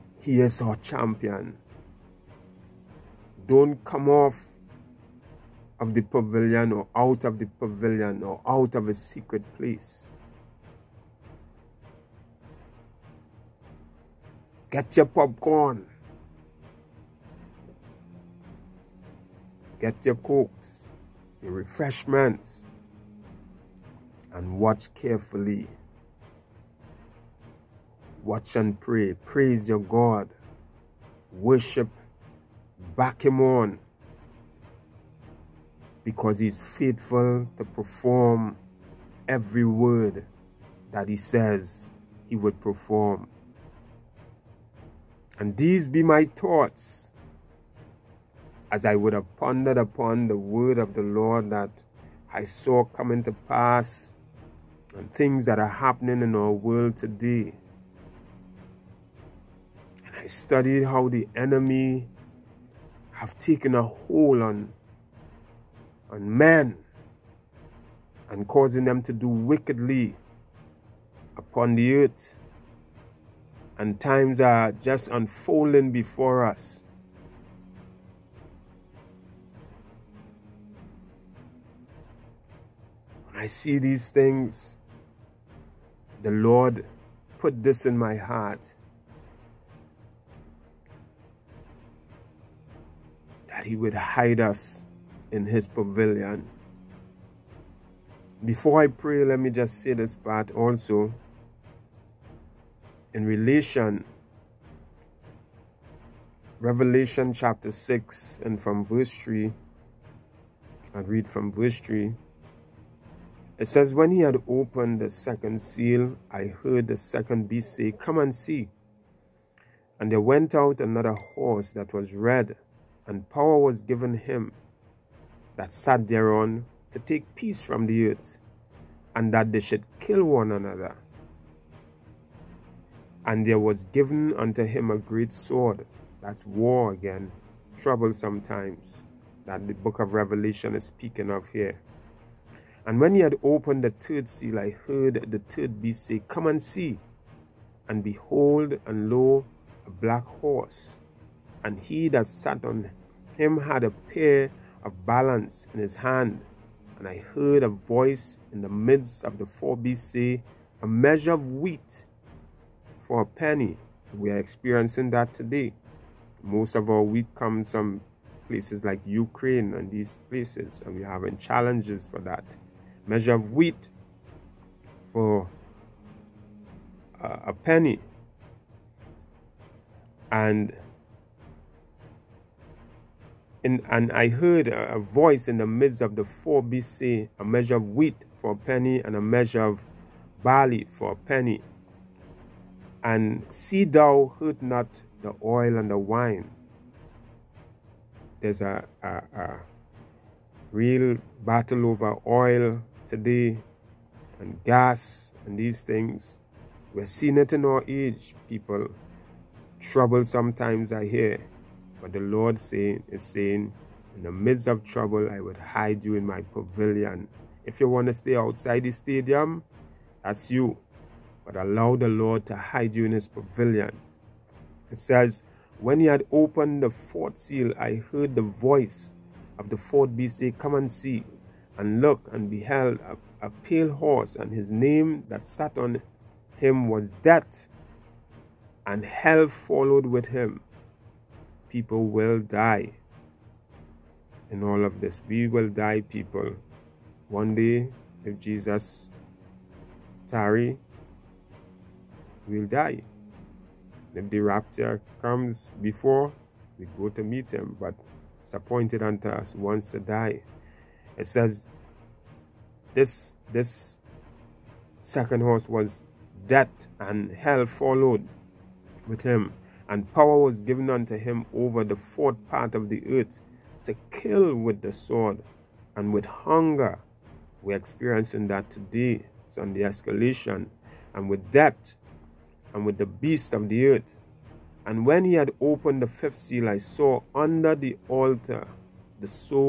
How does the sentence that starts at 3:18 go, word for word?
There's a, a, a real battle over oil yesterday and gas and these things.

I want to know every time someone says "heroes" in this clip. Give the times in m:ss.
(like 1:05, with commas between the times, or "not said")
not said.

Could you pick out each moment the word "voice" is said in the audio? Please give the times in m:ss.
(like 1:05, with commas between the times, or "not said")
2:37, 3:04, 3:48.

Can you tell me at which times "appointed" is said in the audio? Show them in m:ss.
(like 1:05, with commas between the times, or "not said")
4:18.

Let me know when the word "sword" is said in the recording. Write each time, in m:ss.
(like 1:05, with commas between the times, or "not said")
2:15, 4:34.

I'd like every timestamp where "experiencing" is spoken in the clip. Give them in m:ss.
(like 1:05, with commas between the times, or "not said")
2:44, 4:37.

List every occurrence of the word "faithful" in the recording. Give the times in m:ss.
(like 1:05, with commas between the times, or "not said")
0:36.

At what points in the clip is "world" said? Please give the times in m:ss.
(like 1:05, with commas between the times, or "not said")
0:56.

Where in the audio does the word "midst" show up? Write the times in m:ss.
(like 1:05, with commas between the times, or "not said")
2:38, 3:05, 3:34.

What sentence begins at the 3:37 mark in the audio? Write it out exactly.
If you want to stay outside the stadium, that's you.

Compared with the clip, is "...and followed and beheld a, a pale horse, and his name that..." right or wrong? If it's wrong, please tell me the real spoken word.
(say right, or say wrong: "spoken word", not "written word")
wrong: "looked", not "followed".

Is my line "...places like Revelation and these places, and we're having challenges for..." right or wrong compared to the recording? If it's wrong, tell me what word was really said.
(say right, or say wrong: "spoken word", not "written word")
wrong: "Ukraine", not "Revelation".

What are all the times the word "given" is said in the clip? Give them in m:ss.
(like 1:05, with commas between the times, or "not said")
2:03, 2:13, 4:30.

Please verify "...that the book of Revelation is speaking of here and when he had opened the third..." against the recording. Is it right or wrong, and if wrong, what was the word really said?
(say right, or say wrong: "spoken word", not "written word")
right.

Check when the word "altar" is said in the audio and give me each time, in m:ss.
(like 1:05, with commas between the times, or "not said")
4:48.